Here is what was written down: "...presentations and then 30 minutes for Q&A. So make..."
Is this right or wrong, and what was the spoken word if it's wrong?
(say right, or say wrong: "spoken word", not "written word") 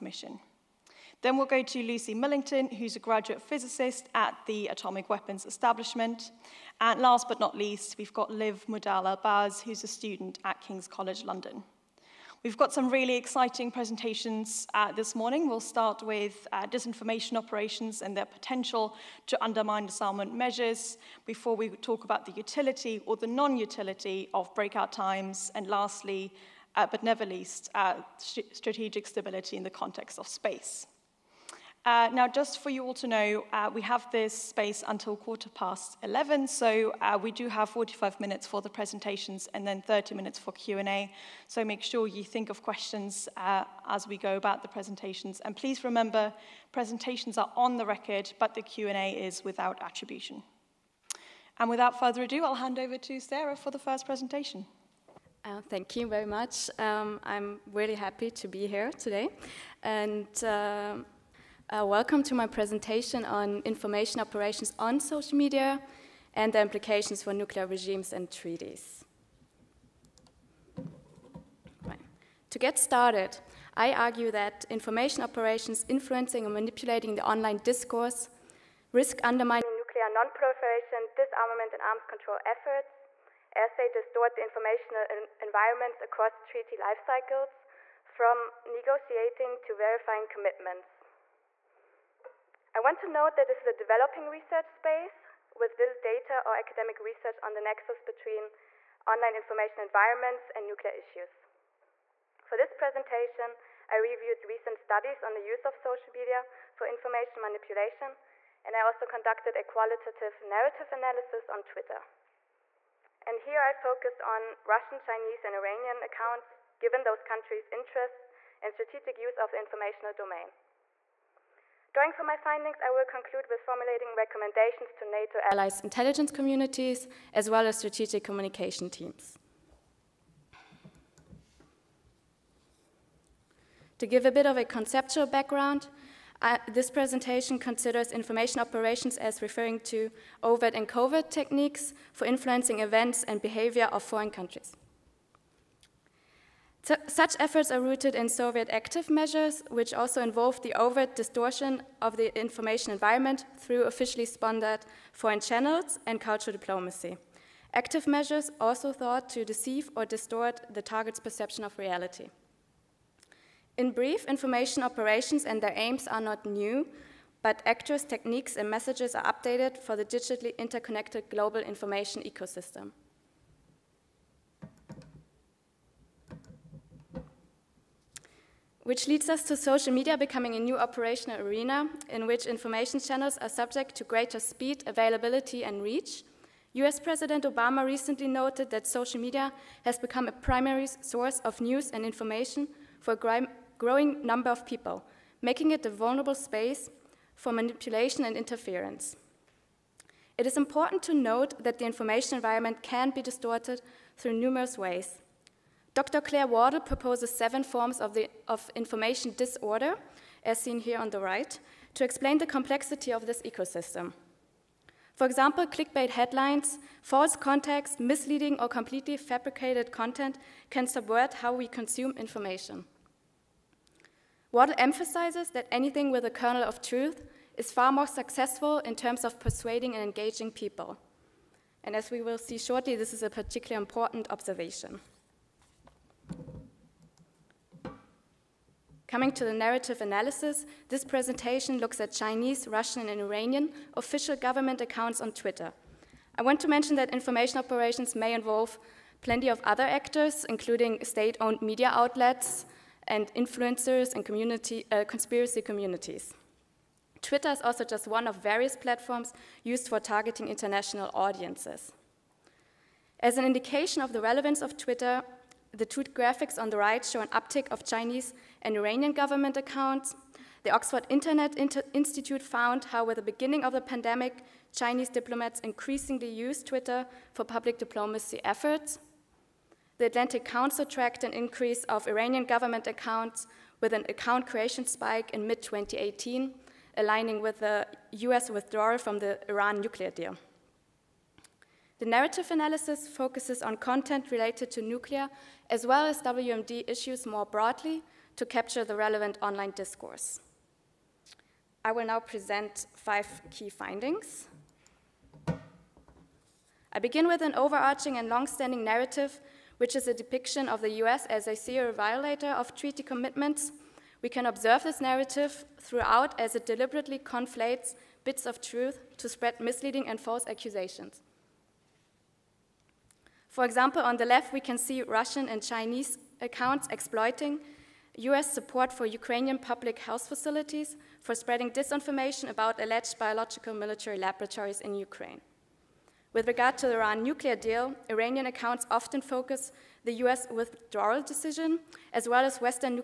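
right.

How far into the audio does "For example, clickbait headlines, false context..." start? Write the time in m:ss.
3:35.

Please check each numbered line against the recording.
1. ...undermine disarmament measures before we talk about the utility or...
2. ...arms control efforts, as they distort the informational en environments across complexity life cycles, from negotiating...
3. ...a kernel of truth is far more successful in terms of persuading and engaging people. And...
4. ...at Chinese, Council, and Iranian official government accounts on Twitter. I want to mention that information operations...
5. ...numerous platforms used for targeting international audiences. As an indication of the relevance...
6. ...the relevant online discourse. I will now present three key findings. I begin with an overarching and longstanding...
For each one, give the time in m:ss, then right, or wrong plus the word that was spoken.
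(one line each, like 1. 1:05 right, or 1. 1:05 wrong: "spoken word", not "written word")
1. 0:19 right
2. 1:21 wrong: "treaty", not "complexity"
3. 3:46 right
4. 4:01 wrong: "Russian", not "Council"
5. 4:18 wrong: "various", not "numerous"
6. 4:58 wrong: "five", not "three".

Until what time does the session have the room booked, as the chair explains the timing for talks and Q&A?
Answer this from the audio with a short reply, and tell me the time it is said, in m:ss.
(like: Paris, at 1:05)
quarter past 11, at 0:35.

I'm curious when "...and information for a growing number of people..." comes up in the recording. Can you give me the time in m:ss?
3:11.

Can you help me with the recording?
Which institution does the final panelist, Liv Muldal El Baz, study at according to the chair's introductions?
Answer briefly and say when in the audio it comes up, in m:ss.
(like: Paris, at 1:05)
King's College London, at 0:10.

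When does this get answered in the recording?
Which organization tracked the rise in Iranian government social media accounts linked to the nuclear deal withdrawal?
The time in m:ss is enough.
4:39.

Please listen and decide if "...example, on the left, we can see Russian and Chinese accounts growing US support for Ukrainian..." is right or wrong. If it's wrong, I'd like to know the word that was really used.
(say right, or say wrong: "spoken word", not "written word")
wrong: "exploiting", not "growing".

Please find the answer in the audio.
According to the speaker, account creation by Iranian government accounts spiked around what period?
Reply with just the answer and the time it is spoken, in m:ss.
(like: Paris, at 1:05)
mid 2018, at 4:45.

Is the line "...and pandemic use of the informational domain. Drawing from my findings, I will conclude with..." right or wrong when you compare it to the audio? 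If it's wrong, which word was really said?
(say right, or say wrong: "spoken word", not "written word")
wrong: "strategic", not "pandemic".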